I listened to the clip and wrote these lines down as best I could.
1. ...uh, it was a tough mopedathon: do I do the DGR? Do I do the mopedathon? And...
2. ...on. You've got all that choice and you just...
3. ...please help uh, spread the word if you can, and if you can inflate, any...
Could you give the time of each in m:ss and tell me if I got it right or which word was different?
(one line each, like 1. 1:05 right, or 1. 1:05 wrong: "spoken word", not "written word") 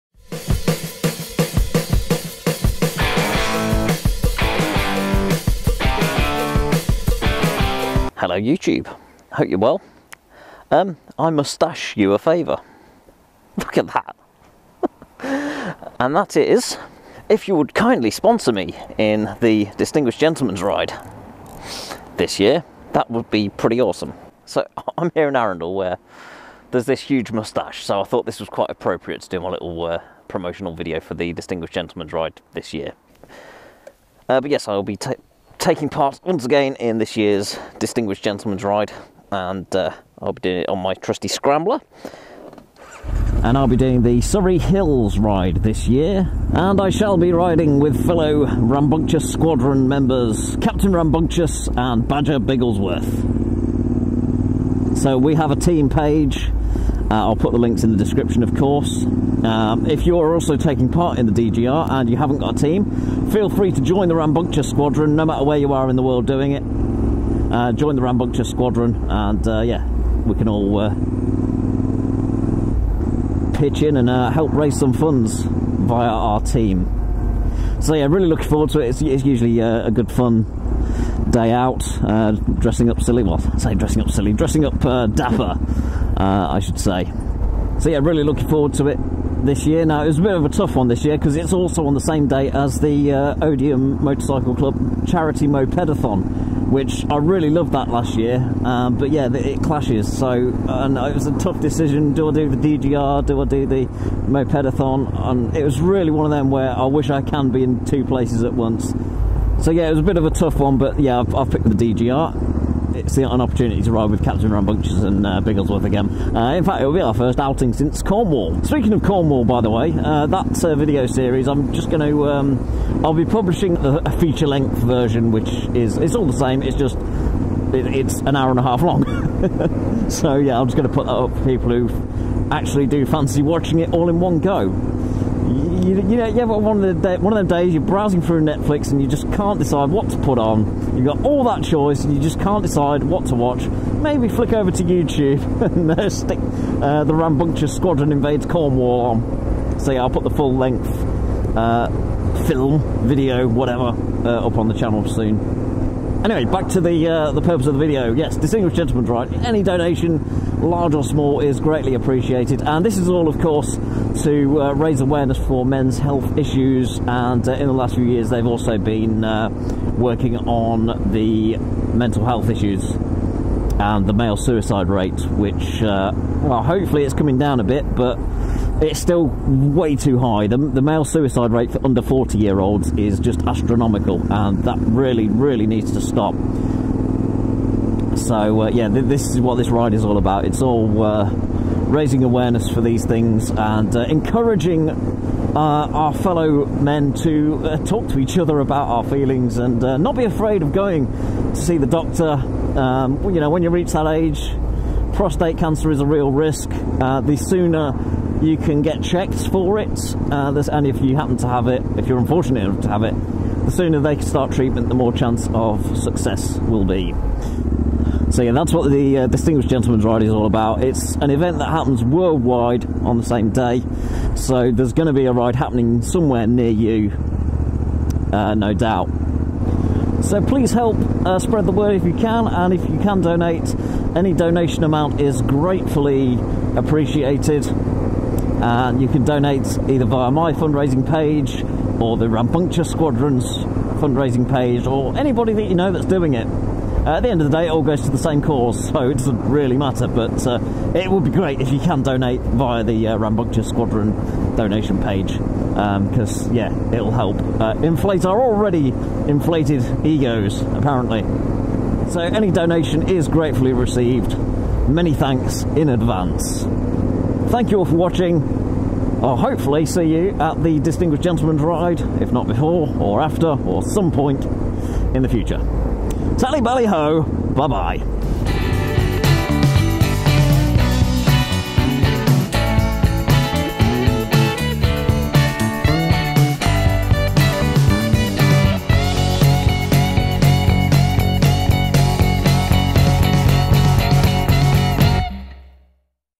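1. 1:40 wrong: "decision", not "mopedathon"
2. 2:20 right
3. 3:50 wrong: "donate", not "inflate".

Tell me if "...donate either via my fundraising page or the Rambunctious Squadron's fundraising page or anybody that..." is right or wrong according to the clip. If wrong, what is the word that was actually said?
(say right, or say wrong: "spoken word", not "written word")
right.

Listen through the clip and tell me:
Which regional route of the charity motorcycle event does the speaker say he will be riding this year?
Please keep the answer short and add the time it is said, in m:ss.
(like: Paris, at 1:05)
Surrey Hills, at 0:44.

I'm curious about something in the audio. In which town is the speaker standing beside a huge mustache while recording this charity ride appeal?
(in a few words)
Arundel.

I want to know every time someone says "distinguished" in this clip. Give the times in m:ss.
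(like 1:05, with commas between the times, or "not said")
0:19, 0:31, 0:37, 2:38, 3:39, 4:30.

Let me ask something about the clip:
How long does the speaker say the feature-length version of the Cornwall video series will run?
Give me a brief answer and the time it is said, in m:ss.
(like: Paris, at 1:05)
An hour and a half, at 2:08.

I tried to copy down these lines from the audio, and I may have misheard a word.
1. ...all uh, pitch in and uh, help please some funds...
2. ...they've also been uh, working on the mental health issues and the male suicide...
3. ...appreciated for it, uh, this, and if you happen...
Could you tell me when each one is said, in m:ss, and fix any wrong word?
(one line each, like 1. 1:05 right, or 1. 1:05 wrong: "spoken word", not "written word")
1. 1:10 wrong: "raise", not "please"
2. 2:48 right
3. 3:29 wrong: "checked", not "appreciated".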